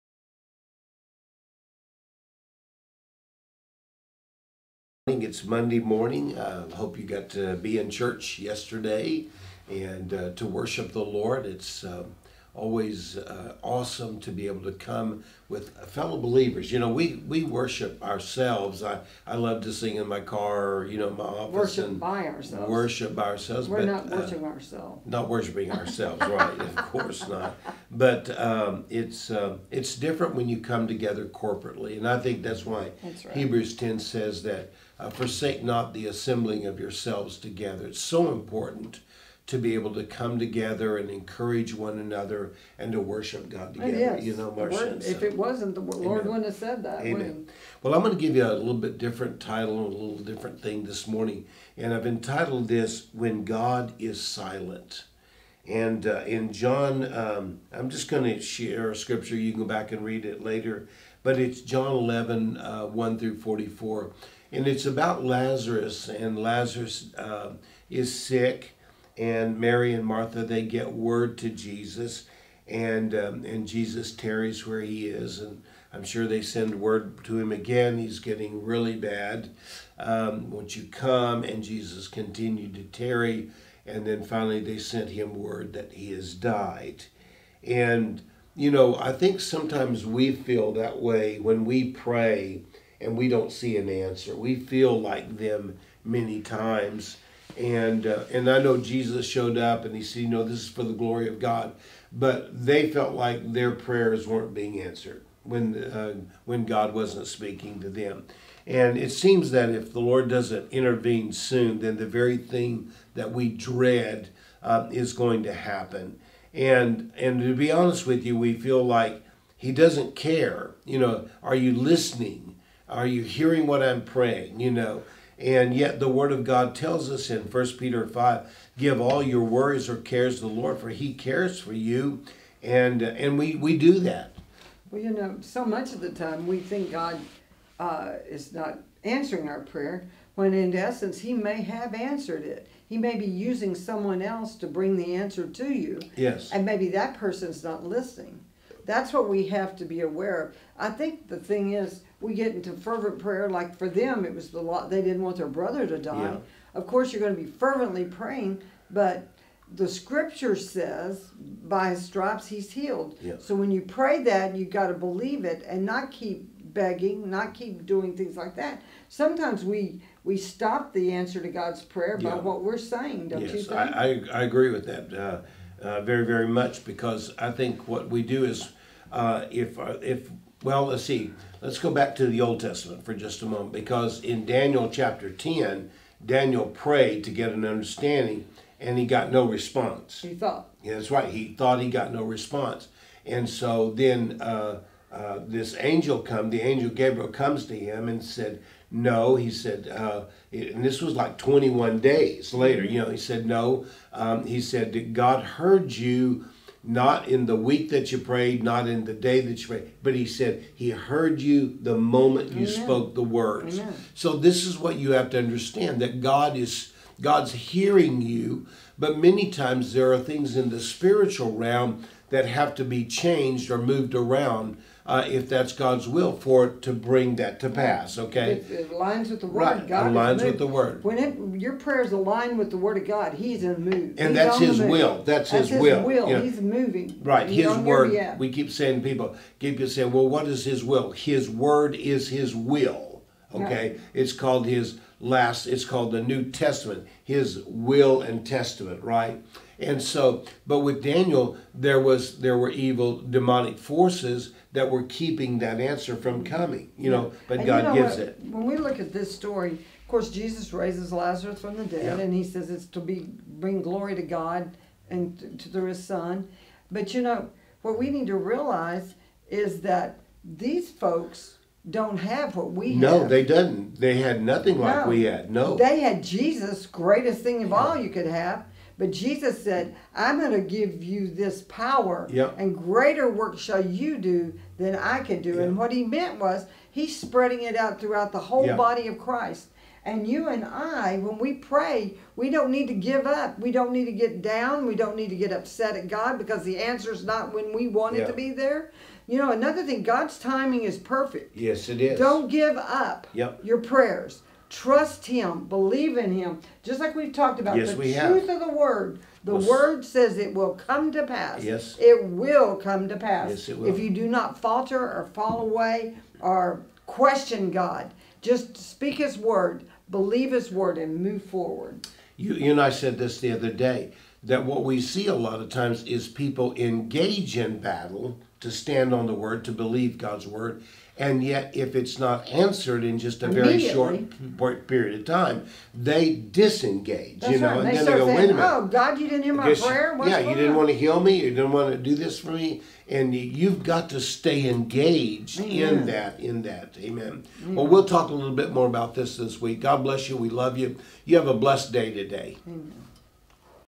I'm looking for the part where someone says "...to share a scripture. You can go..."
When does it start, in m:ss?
0:58.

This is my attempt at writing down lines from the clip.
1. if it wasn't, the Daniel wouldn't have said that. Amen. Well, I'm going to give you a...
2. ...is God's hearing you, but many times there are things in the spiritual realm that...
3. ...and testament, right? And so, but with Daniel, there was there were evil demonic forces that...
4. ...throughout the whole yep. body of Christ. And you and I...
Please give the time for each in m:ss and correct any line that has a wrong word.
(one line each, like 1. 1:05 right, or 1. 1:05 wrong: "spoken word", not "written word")
1. 0:45 wrong: "Lord", not "Daniel"
2. 3:36 right
3. 4:08 right
4. 4:47 right.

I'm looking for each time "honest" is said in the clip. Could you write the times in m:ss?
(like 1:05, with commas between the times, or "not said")
1:57.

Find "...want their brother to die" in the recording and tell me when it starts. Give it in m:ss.
2:35.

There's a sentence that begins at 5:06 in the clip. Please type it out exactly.
Just like we've talked about, yes, the we truth have.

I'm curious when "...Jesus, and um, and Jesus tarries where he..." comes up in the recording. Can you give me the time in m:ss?
1:11.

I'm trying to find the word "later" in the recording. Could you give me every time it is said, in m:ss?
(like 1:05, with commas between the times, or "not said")
1:00, 3:22.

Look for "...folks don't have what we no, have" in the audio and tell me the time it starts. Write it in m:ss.
4:30.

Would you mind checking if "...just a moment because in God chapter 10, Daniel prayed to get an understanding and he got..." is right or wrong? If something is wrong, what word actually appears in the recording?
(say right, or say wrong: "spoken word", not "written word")
wrong: "Daniel", not "God".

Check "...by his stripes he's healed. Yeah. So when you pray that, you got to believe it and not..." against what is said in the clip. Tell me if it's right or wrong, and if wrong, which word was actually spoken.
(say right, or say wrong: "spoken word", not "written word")
right.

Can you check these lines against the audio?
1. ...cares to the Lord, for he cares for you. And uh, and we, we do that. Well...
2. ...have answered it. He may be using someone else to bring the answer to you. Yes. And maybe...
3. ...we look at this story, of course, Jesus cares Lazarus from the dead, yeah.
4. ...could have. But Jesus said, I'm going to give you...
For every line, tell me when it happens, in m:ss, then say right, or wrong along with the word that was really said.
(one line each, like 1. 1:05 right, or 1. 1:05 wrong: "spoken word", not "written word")
1. 2:09 right
2. 2:21 right
3. 4:18 wrong: "raises", not "cares"
4. 4:38 right.